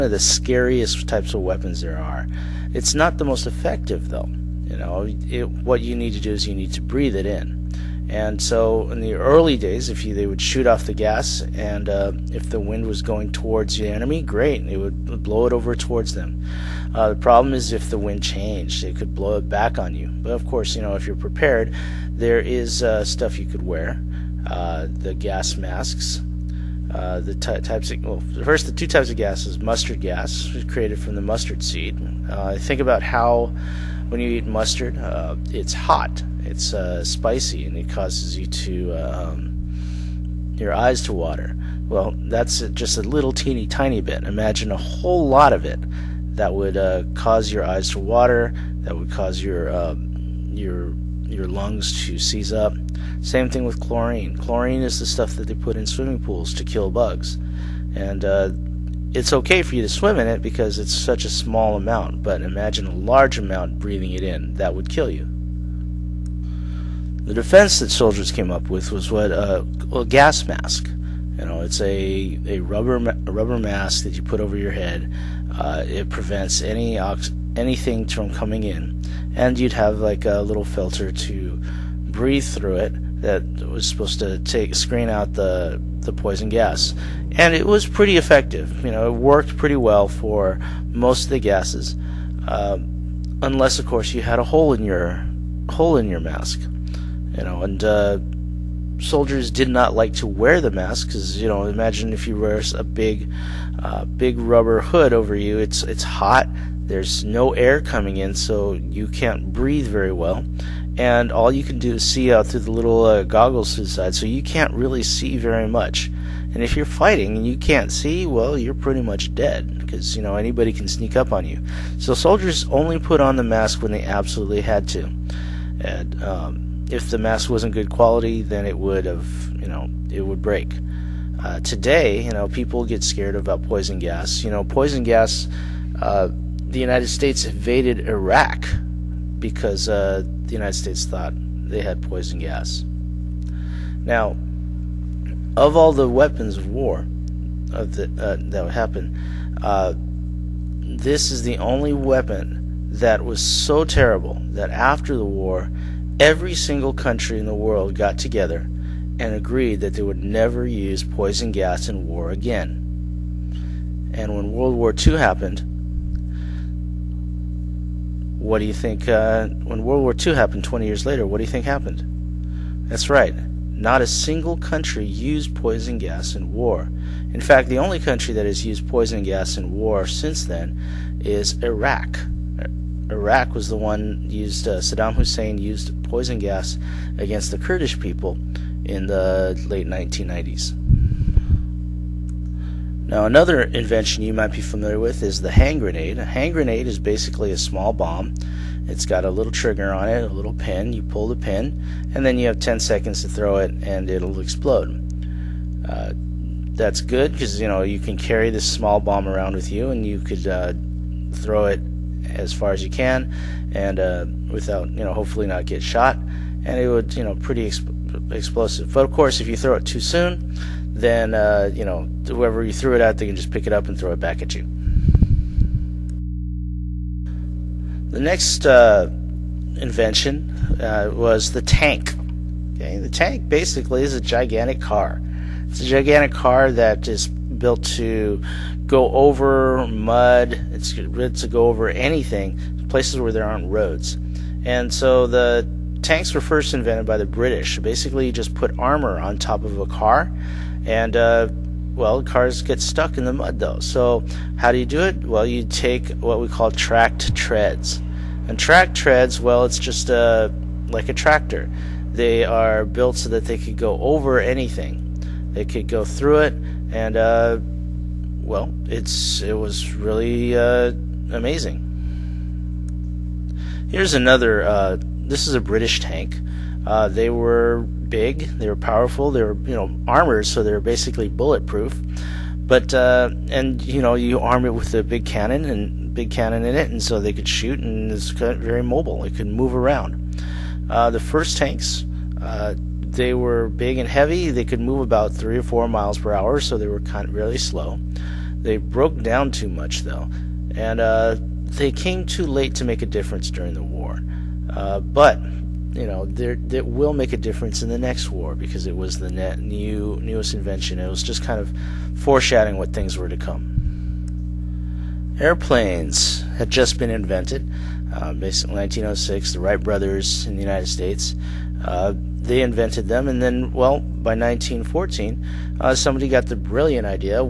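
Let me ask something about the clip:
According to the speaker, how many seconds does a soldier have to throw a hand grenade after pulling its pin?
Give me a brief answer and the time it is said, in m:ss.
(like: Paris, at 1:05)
10, at 3:22.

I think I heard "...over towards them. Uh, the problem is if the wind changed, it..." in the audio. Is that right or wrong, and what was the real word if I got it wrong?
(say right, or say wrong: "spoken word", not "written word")
right.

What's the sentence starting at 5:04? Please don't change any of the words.
Uh, but you know, that will make a difference in the next war because it was the net new newest invention.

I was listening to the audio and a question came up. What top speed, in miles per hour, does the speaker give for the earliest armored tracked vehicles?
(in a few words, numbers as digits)
3 or 4.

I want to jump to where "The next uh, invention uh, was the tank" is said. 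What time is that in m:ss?
3:48.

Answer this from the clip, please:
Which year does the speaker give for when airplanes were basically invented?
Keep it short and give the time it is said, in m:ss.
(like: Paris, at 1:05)
1906, at 5:18.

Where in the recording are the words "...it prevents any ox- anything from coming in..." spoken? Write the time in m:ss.
1:15.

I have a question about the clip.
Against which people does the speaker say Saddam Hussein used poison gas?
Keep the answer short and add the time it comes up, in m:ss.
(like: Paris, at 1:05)
the Kurdish people, at 3:07.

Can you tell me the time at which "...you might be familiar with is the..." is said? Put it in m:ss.
3:14.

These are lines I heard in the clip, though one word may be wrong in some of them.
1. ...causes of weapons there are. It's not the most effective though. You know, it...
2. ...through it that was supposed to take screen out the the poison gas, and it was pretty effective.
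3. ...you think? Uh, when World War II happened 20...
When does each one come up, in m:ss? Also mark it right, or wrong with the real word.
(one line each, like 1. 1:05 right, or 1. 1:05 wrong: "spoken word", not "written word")
1. 0:01 wrong: "types", not "causes"
2. 1:22 right
3. 2:48 right.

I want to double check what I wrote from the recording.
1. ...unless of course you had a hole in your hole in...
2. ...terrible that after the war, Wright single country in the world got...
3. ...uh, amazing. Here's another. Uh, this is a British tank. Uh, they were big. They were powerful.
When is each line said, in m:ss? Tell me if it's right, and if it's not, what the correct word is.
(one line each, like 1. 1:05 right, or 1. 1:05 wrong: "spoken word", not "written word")
1. 1:33 right
2. 2:33 wrong: "Every", not "Wright"
3. 4:30 right.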